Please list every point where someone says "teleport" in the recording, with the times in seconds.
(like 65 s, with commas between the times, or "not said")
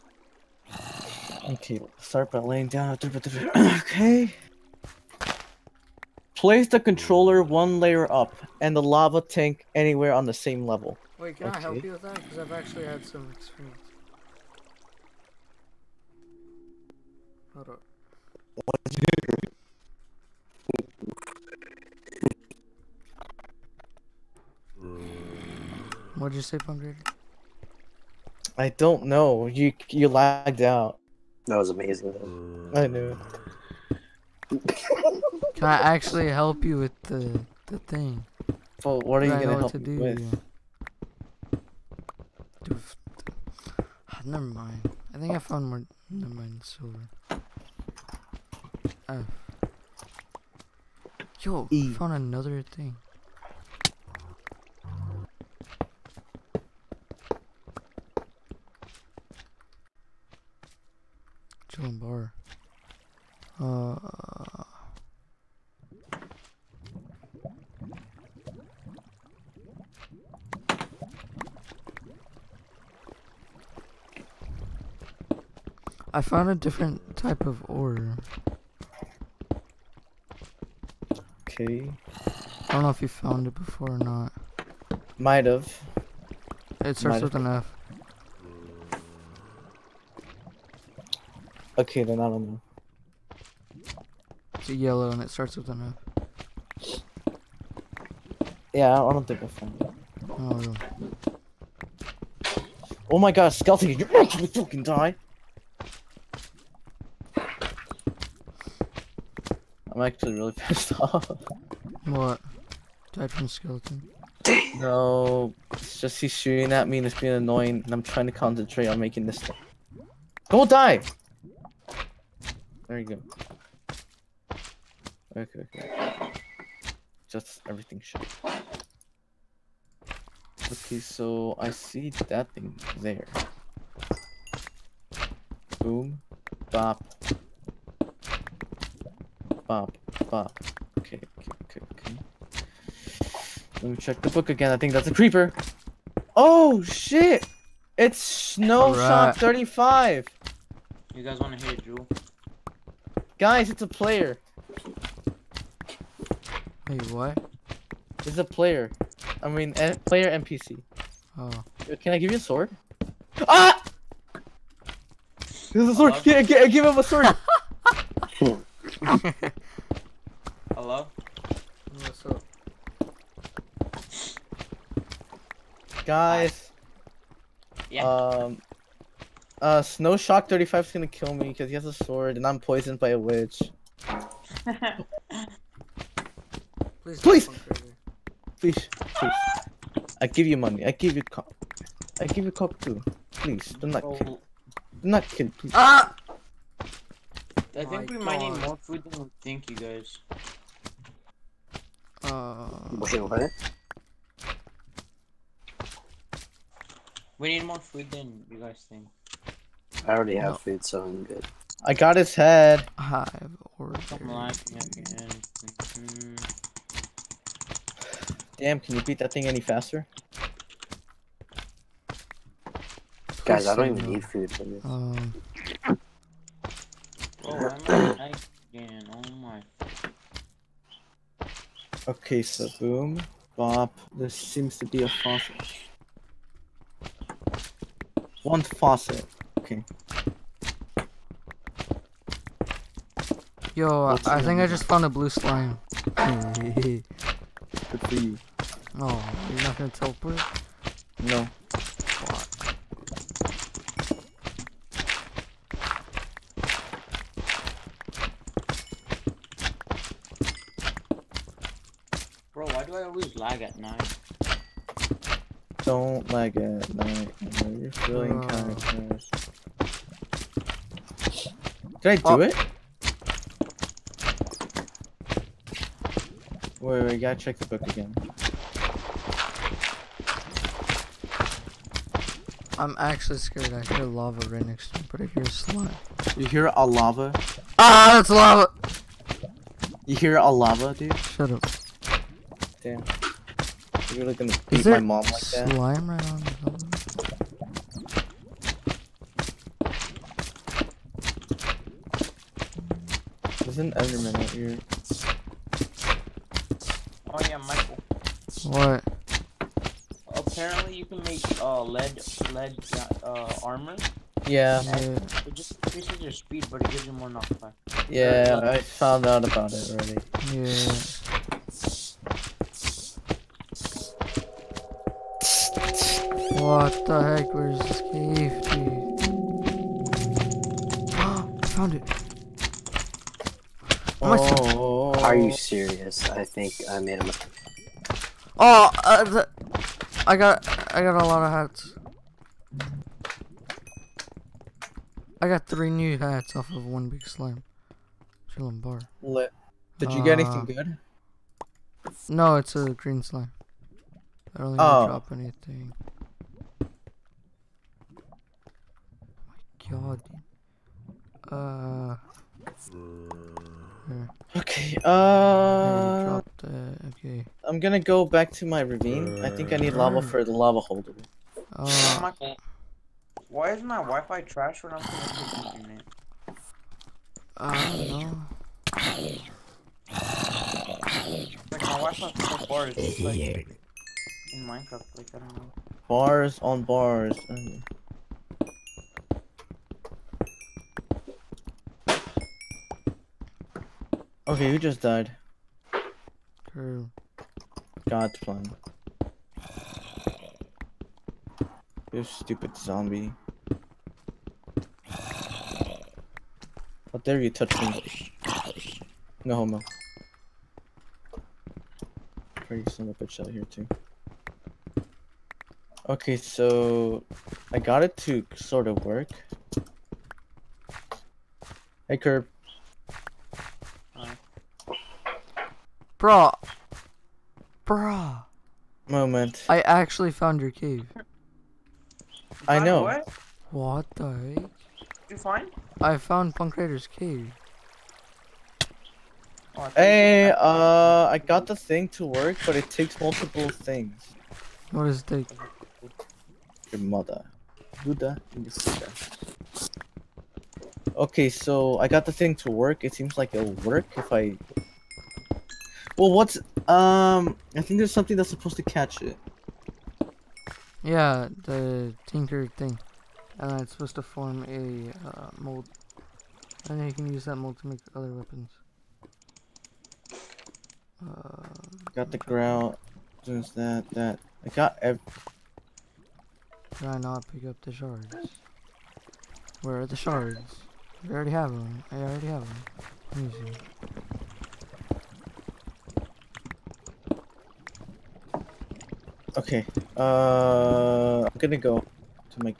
249 s.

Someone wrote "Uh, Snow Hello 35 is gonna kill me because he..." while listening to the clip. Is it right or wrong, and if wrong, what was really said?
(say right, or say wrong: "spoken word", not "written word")
wrong: "Shock", not "Hello".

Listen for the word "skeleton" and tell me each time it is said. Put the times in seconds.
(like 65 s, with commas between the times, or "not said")
103 s, 113 s.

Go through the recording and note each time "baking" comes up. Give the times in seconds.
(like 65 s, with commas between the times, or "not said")
not said.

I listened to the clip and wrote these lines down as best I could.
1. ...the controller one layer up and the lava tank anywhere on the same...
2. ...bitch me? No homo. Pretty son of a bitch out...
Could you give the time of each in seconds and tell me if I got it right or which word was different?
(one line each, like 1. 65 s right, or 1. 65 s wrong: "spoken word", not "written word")
1. 6 s right
2. 407 s wrong: "touch", not "bitch".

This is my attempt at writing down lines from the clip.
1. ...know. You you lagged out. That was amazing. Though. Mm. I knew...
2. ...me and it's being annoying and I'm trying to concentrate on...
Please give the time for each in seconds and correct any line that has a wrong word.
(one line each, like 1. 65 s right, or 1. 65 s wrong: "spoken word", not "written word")
1. 29 s right
2. 116 s right.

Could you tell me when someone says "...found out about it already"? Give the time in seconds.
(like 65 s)
318 s.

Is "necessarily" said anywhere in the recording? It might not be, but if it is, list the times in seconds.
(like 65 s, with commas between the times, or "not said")
not said.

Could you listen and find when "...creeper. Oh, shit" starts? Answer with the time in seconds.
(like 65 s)
145 s.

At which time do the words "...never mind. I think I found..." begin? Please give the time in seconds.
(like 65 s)
44 s.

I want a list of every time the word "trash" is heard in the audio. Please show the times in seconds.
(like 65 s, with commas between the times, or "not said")
269 s, 374 s.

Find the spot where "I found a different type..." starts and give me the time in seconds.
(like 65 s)
76 s.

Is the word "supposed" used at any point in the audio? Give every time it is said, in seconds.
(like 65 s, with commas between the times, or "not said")
458 s, 463 s.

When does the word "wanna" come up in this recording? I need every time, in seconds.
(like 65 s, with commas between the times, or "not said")
151 s.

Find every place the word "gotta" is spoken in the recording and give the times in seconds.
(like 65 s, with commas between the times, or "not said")
277 s.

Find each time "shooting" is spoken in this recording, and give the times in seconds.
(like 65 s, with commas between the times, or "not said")
116 s.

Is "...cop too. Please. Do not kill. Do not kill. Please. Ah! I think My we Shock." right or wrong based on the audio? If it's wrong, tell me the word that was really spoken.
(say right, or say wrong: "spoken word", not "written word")
wrong: "God", not "Shock".